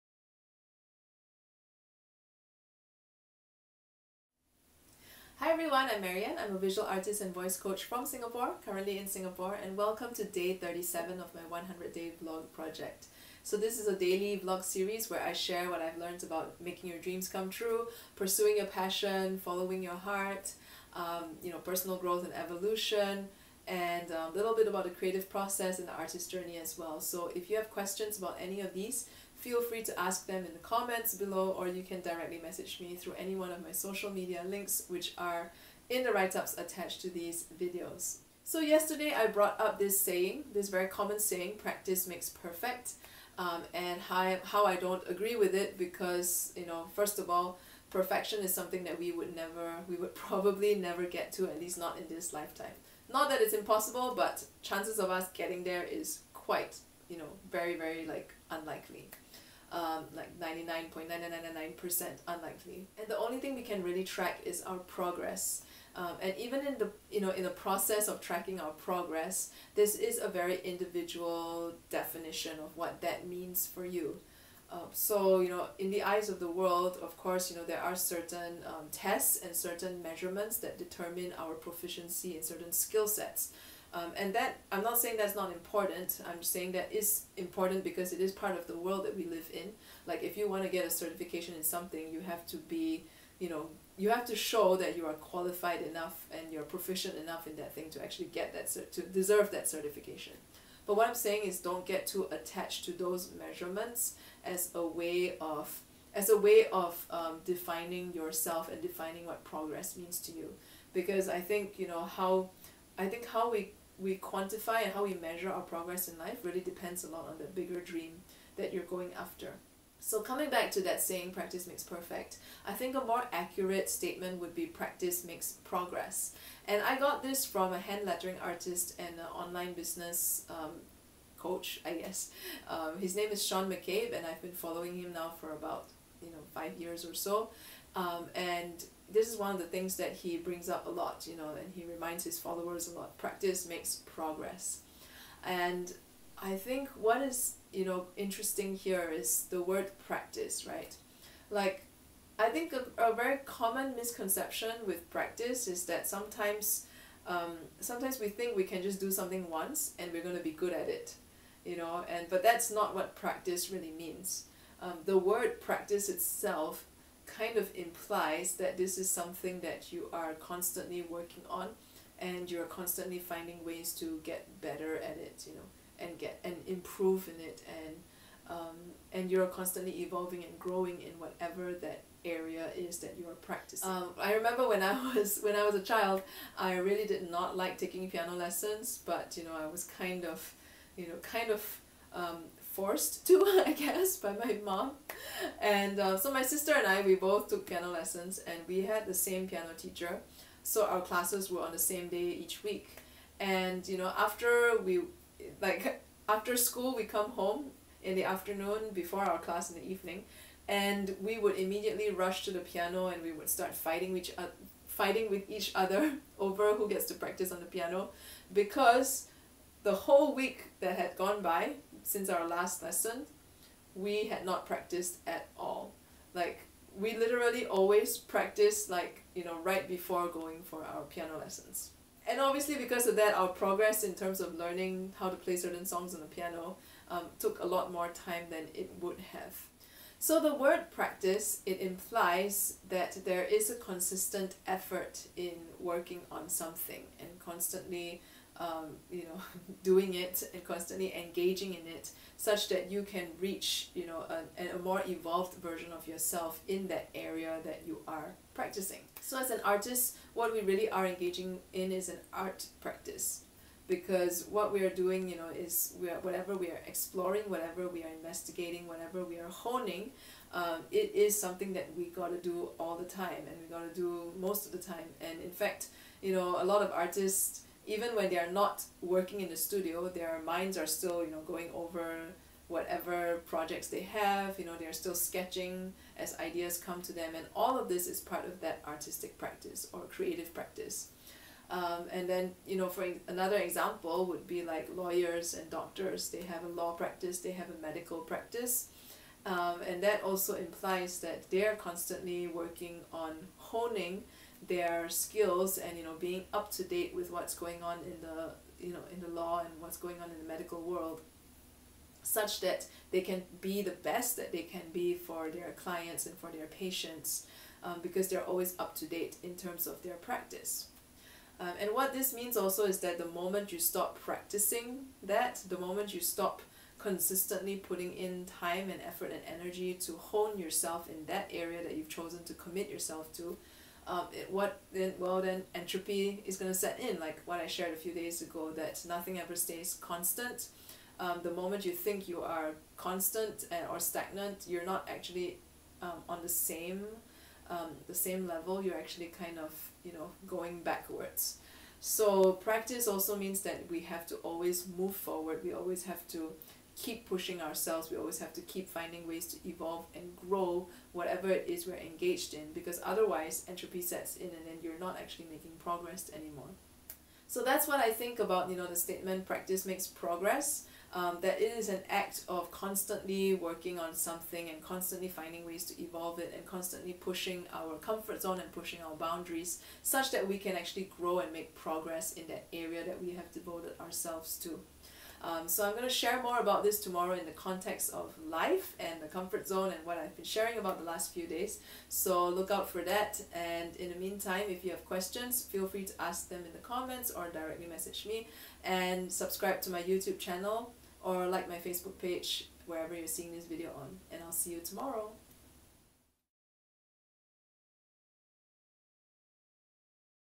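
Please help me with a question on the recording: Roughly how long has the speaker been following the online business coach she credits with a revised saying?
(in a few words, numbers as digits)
5 years.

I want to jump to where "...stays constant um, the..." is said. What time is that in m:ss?
5:39.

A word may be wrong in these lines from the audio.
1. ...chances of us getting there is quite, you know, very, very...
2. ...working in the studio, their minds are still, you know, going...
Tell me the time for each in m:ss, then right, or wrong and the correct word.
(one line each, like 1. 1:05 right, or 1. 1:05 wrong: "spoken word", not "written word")
1. 0:54 right
2. 4:39 right.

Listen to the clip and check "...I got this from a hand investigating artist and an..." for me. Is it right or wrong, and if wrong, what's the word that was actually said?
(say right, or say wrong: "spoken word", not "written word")
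wrong: "lettering", not "investigating".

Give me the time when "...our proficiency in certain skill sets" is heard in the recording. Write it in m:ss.
1:21.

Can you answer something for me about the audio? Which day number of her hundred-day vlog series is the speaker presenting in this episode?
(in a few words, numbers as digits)
37.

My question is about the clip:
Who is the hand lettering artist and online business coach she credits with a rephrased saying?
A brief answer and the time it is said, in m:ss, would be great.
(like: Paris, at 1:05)
Sean McCabe, at 2:13.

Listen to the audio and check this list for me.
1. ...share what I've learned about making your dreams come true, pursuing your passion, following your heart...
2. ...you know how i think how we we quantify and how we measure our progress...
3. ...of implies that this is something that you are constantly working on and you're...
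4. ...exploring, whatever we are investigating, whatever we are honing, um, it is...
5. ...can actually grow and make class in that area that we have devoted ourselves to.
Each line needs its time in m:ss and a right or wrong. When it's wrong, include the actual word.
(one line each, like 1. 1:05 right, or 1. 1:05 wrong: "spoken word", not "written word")
1. 0:15 right
2. 1:51 right
3. 2:47 right
4. 4:26 right
5. 6:20 wrong: "progress", not "class".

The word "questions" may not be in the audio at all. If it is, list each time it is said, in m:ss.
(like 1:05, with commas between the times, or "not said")
0:27, 6:35.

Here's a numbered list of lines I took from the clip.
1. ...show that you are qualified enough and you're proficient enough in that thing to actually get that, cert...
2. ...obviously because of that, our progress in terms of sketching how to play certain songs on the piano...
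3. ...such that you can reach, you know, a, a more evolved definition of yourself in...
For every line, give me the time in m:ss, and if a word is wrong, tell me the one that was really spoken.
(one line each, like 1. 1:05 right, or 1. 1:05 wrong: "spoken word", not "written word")
1. 1:34 right
2. 3:52 wrong: "learning", not "sketching"
3. 4:12 wrong: "version", not "definition".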